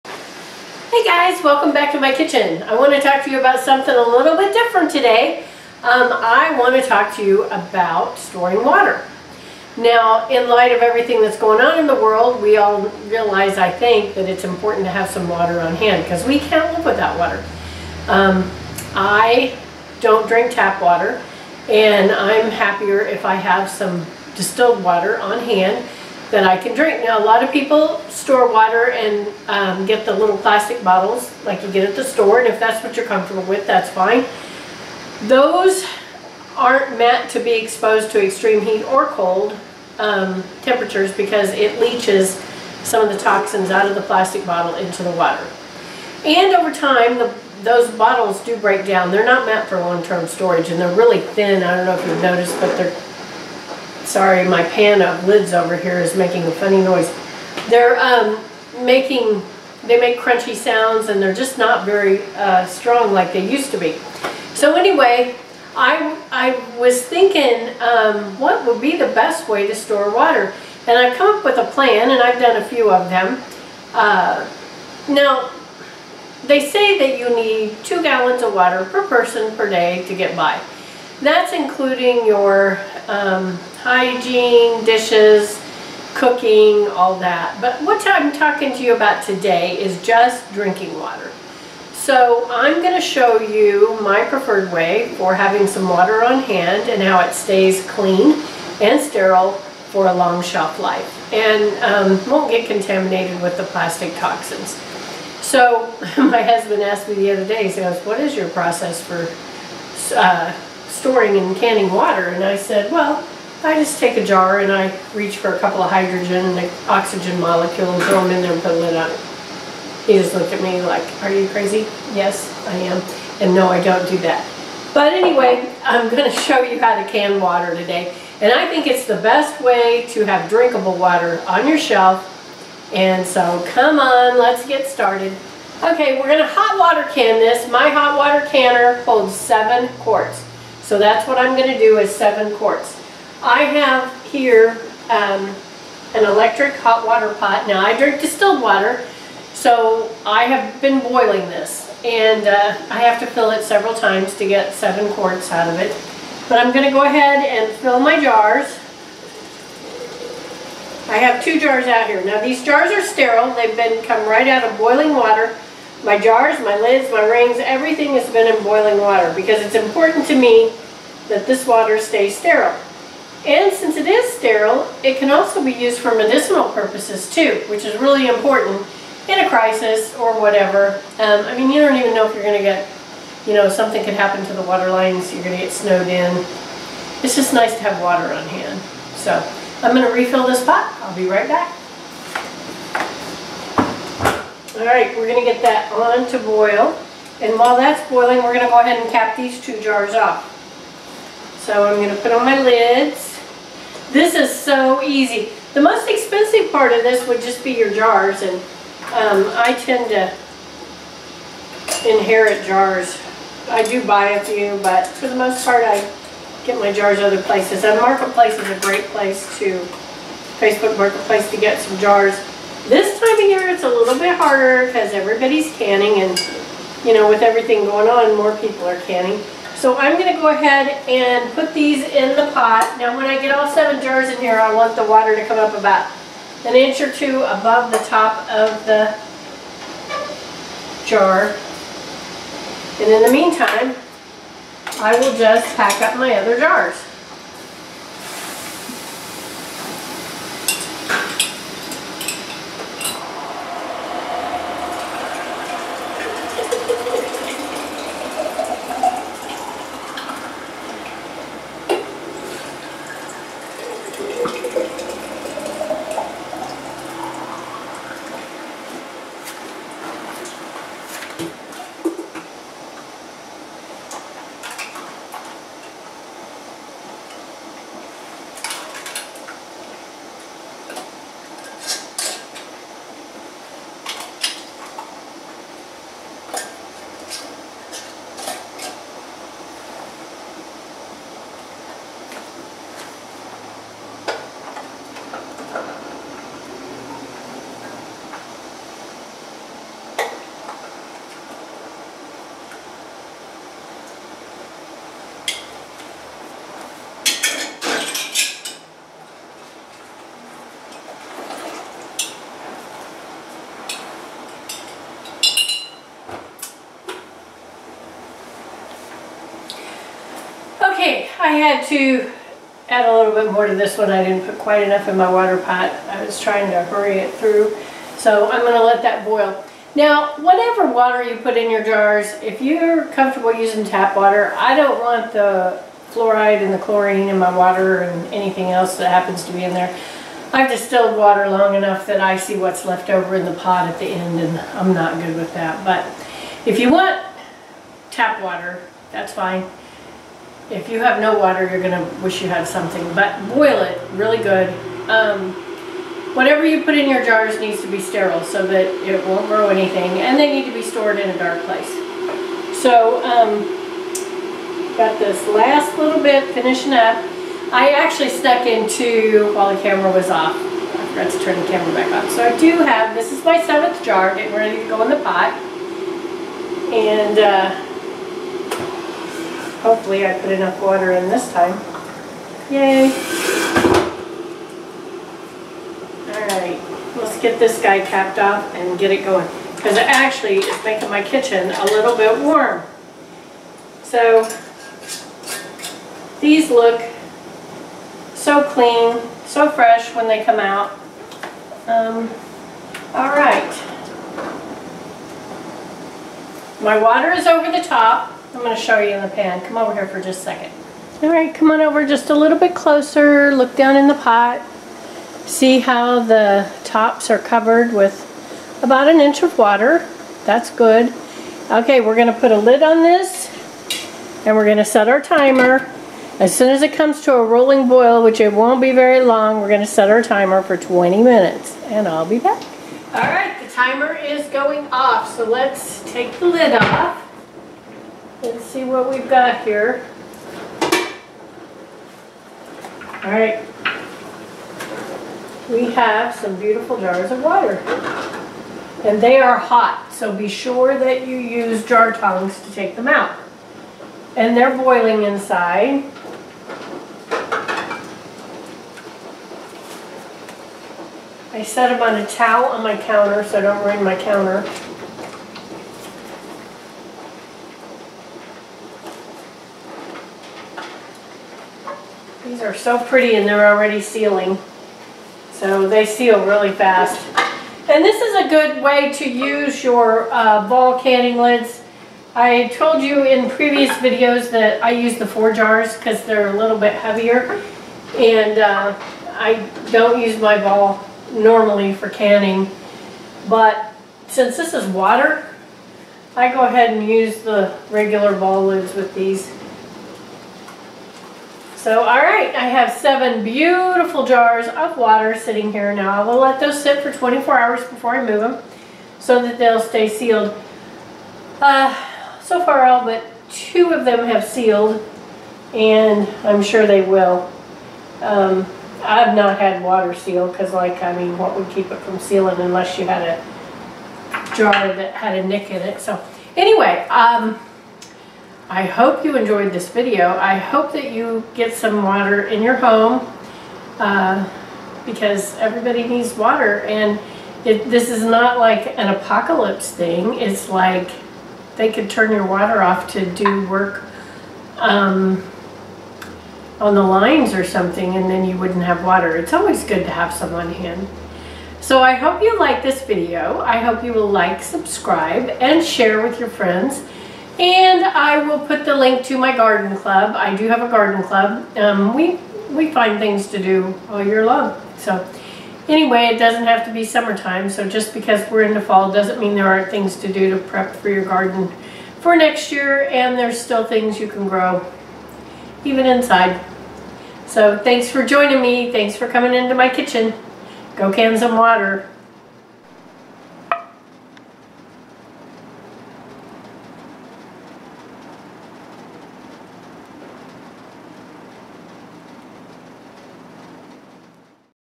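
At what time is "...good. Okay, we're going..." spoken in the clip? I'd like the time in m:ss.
7:00.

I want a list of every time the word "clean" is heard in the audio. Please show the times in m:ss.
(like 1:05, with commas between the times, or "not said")
1:37, 6:38.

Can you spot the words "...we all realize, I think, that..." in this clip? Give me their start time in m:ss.
0:12.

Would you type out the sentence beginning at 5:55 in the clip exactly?
Um, whatever you put in your jars needs to be sterile so that it won't grow anything.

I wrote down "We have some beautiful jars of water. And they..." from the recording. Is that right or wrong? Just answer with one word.
right.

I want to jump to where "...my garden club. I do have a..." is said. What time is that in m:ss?
9:19.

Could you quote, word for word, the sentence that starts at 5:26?
I was trying to hurry it through.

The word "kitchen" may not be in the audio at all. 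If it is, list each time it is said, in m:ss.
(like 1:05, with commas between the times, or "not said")
0:02, 6:31, 9:39.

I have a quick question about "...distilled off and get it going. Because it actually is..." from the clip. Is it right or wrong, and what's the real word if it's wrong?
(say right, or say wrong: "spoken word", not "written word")
wrong: "capped", not "distilled".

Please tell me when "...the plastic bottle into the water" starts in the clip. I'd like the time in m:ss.
0:43.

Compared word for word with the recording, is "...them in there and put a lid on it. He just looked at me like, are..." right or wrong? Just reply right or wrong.
right.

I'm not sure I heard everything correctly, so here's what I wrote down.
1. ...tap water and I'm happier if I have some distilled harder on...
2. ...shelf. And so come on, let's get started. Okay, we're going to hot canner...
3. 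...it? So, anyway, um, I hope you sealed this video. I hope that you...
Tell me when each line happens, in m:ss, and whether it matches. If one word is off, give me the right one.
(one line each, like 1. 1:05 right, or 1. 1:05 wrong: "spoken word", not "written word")
1. 0:20 wrong: "water", not "harder"
2. 2:11 wrong: "water", not "canner"
3. 8:45 wrong: "enjoyed", not "sealed".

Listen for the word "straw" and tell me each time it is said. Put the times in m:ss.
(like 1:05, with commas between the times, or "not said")
not said.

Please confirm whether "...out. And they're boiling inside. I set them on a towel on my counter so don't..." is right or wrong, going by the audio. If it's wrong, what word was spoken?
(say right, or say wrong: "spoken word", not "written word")
right.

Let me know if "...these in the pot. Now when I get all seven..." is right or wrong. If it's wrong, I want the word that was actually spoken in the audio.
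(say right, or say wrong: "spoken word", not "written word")
right.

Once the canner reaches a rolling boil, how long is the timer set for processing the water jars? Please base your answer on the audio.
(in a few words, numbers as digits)
20 minutes.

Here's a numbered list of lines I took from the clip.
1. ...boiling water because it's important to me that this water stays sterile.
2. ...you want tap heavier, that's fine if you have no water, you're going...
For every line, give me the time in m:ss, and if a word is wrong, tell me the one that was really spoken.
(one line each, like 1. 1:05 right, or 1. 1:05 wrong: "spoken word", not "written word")
1. 2:48 right
2. 5:46 wrong: "water", not "heavier".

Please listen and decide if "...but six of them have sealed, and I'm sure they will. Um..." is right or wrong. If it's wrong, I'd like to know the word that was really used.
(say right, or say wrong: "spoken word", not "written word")
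wrong: "two", not "six".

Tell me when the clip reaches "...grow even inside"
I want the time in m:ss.
9:34.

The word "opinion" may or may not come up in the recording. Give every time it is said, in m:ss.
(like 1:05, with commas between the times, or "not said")
not said.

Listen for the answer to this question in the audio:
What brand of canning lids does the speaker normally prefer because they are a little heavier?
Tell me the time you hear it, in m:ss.
8:05.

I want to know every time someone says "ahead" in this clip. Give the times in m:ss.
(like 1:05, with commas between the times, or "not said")
2:37, 3:18, 3:50, 8:16.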